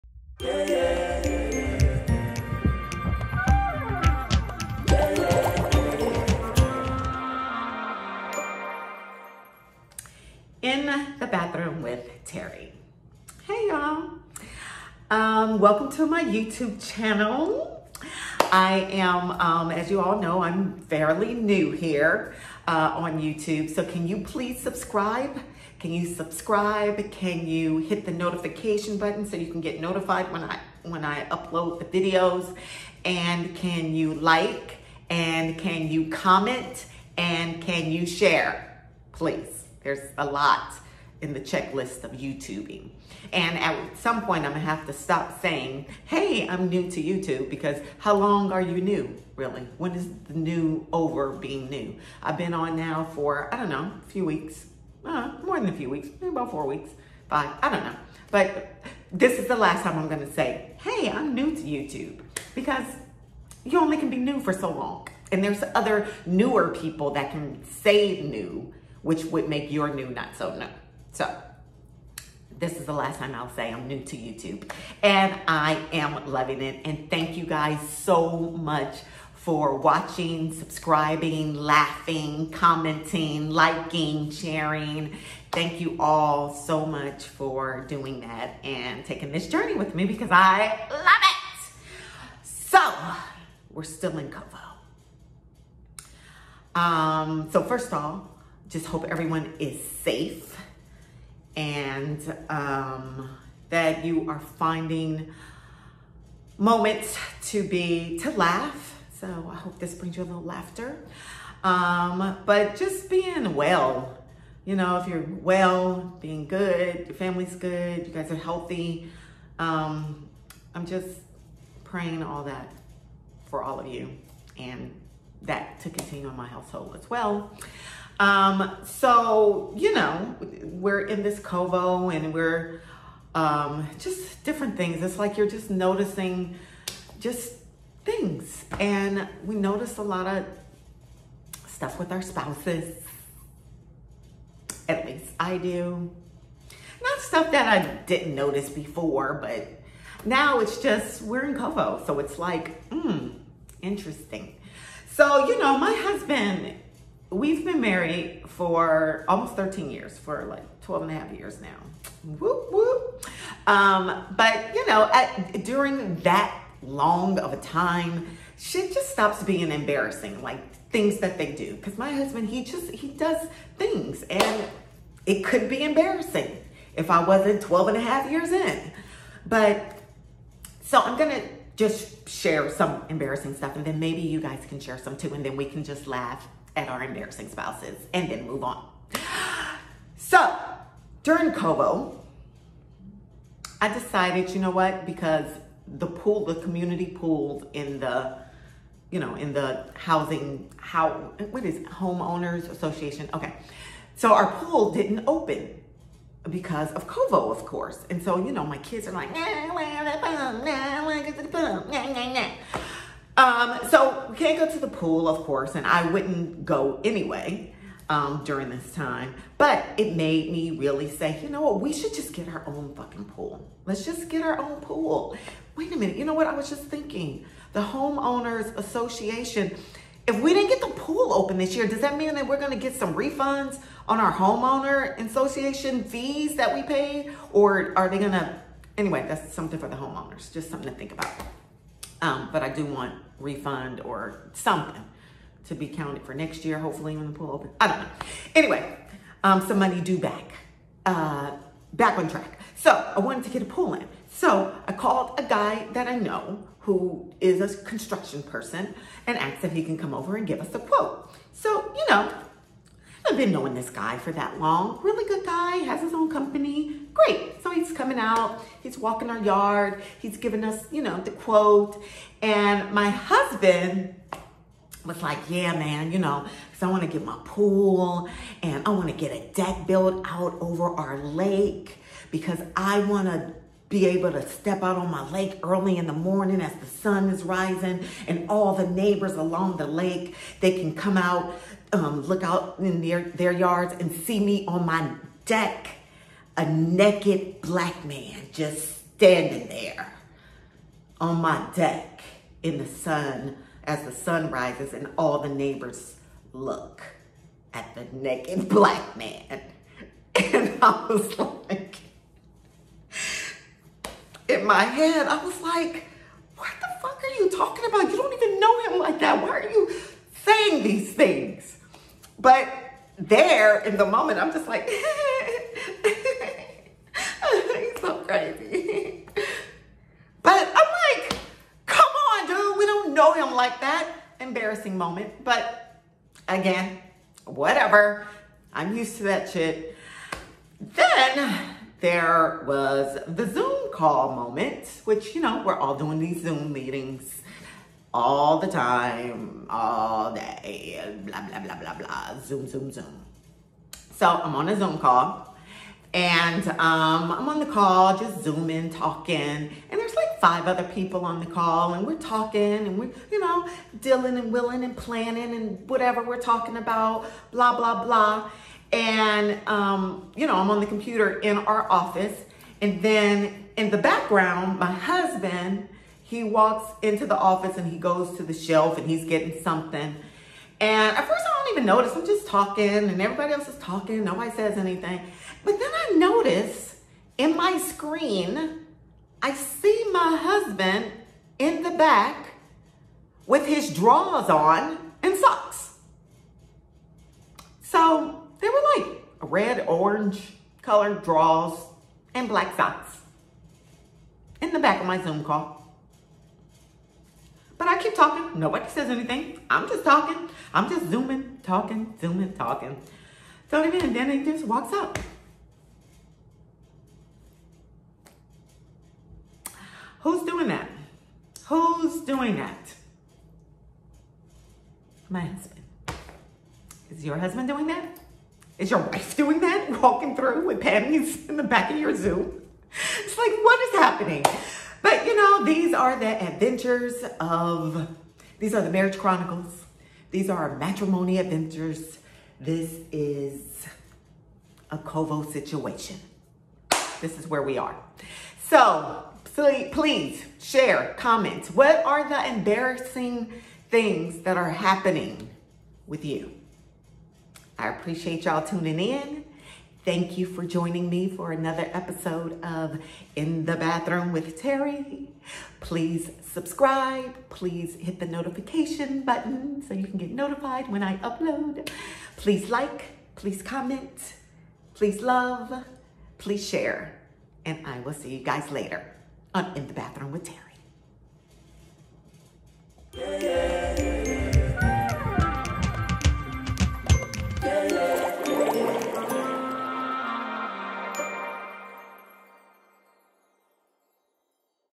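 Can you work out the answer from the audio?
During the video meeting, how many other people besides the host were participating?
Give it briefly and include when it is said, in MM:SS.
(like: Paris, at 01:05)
5, at 06:00.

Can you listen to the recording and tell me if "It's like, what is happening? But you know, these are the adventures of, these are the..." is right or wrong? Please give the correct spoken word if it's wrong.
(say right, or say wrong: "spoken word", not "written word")
right.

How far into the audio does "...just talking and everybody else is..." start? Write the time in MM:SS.
06:22.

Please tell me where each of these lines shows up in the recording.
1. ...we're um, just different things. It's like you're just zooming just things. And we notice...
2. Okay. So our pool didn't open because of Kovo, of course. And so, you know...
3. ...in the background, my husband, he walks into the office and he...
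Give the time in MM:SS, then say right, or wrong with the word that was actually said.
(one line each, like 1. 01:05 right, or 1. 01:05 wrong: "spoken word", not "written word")
1. 02:12 wrong: "noticing", not "zooming"
2. 03:23 right
3. 06:13 right.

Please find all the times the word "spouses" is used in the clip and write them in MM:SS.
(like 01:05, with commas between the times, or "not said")
02:22, 03:07.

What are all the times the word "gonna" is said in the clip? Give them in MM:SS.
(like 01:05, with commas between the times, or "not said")
00:44, 01:00.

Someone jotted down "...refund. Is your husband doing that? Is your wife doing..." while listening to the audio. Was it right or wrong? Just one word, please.
wrong.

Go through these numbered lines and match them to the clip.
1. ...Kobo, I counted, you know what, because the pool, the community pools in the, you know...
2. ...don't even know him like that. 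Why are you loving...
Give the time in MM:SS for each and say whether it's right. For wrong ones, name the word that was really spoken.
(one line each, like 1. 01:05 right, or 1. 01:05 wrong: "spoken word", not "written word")
1. 03:11 wrong: "decided", not "counted"
2. 05:18 wrong: "saying", not "loving".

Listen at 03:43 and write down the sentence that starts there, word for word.
Let's just get our own pool.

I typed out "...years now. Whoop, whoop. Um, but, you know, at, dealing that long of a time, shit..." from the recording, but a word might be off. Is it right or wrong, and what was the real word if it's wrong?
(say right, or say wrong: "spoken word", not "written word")
wrong: "during", not "dealing".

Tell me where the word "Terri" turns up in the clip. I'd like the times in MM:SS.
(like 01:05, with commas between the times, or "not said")
00:12, 07:44, 08:00.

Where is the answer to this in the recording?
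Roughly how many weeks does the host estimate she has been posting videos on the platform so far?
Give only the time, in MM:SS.
00:56.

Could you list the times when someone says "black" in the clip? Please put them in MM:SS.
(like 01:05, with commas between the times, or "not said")
04:57, 05:08, 06:42.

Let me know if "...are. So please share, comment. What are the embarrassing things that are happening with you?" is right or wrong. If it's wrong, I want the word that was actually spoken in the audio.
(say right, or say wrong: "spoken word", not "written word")
right.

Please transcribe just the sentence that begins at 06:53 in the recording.
Don't even, and then he just walks up.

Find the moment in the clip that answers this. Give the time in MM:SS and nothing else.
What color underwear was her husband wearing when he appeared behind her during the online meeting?
06:39.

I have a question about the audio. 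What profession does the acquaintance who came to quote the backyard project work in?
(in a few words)
Construction.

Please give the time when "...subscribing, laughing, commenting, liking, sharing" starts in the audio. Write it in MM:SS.
01:20.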